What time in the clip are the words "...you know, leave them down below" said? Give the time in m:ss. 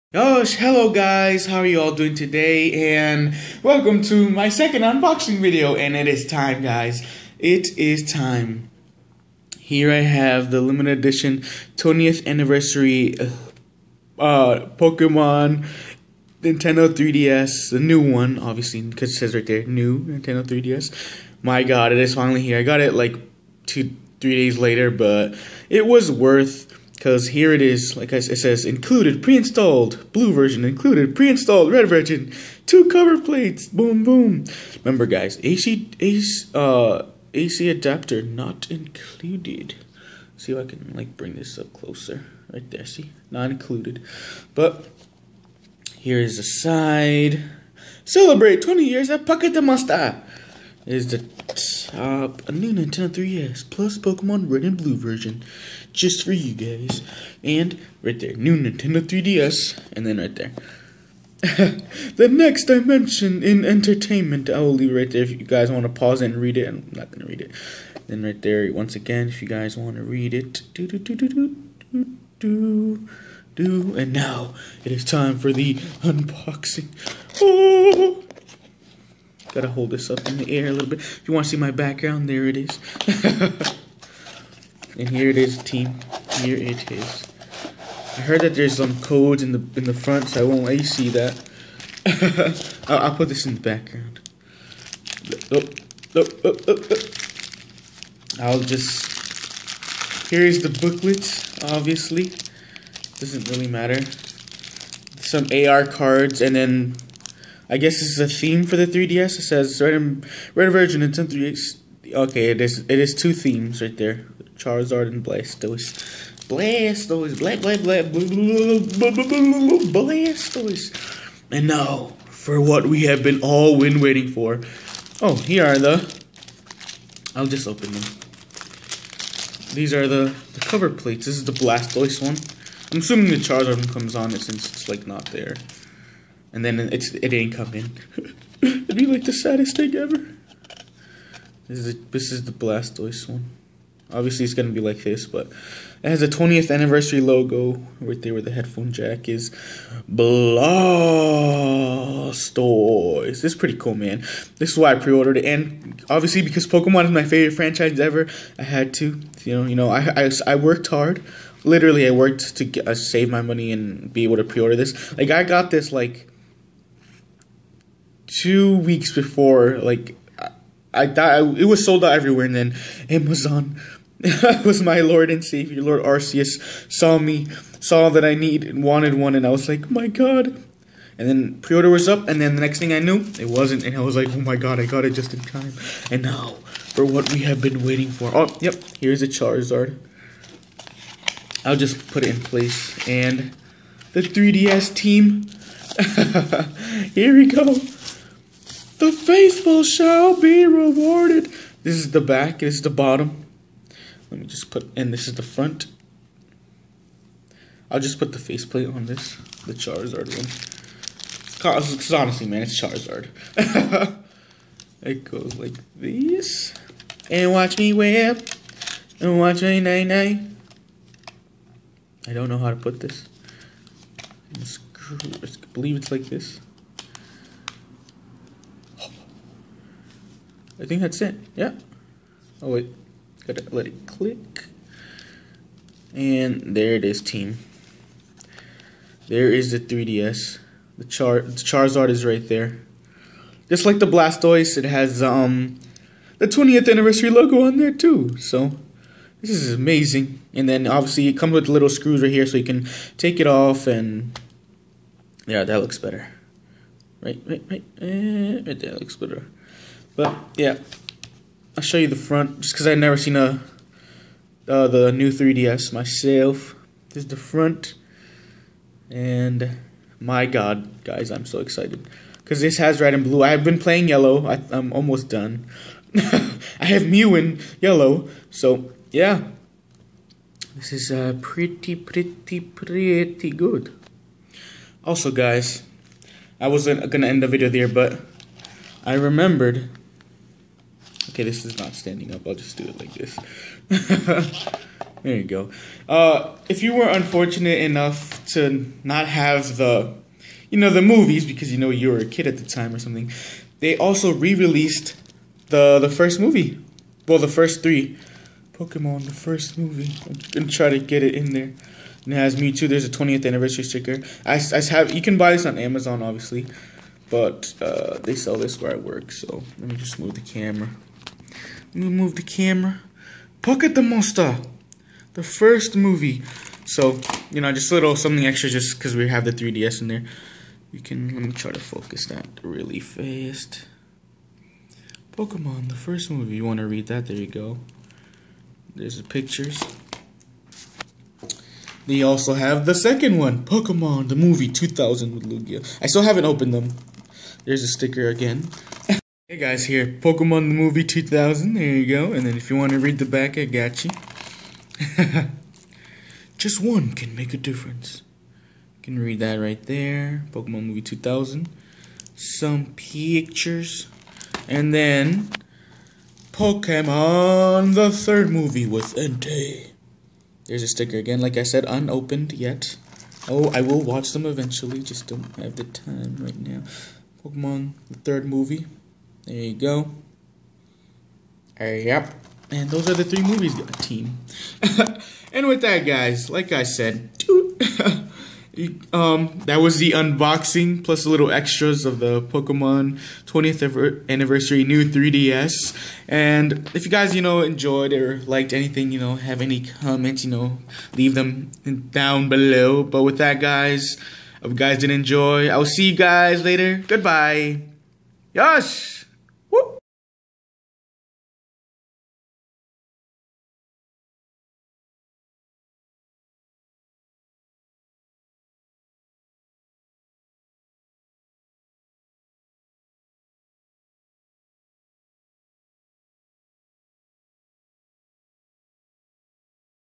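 6:40.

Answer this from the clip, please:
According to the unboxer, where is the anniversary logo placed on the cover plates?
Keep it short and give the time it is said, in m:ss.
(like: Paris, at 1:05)
Where the headphone jack is, at 2:28.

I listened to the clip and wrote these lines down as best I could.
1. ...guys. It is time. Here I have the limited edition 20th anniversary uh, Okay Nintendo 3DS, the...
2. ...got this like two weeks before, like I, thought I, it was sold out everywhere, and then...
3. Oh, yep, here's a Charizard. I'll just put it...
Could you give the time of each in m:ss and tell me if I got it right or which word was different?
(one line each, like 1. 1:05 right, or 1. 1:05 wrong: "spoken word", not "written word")
1. 0:06 wrong: "Pokemon", not "Okay"
2. 2:45 right
3. 3:08 right.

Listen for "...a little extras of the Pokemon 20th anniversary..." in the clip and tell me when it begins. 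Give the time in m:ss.
6:31.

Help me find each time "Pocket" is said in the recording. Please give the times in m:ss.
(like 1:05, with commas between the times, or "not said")
0:49, 5:23.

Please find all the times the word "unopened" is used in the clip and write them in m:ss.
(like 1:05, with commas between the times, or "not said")
6:11.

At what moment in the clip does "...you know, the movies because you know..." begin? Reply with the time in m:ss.
5:00.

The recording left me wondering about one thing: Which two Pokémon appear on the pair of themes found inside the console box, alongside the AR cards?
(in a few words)
Charizard and Blastoise.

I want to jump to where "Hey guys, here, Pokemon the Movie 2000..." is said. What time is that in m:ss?
5:49.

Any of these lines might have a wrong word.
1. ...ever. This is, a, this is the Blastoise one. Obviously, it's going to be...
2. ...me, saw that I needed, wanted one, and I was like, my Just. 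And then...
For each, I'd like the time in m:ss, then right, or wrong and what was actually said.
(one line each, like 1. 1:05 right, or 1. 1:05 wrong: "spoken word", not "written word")
1. 2:19 right
2. 2:57 wrong: "God", not "Just".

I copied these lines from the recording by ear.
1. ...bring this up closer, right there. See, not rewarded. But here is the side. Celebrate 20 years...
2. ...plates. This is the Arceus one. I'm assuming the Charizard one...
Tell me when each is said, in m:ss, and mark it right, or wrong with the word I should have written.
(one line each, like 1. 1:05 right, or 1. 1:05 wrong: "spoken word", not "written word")
1. 0:41 wrong: "included", not "rewarded"
2. 2:10 wrong: "Blastoise", not "Arceus".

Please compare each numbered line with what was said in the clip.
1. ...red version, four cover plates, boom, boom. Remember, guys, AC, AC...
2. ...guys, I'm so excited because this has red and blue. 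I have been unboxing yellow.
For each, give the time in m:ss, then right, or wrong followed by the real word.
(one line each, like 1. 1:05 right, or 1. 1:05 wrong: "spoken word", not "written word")
1. 0:31 wrong: "two", not "four"
2. 4:31 wrong: "playing", not "unboxing".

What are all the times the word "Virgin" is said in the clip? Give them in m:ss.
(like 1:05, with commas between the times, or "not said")
1:50.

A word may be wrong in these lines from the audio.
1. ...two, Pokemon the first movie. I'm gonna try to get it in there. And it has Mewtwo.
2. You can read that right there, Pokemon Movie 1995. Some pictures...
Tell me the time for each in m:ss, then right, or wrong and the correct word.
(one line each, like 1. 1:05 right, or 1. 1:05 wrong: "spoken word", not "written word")
1. 5:07 wrong: "three", not "two"
2. 5:58 wrong: "2000", not "1995".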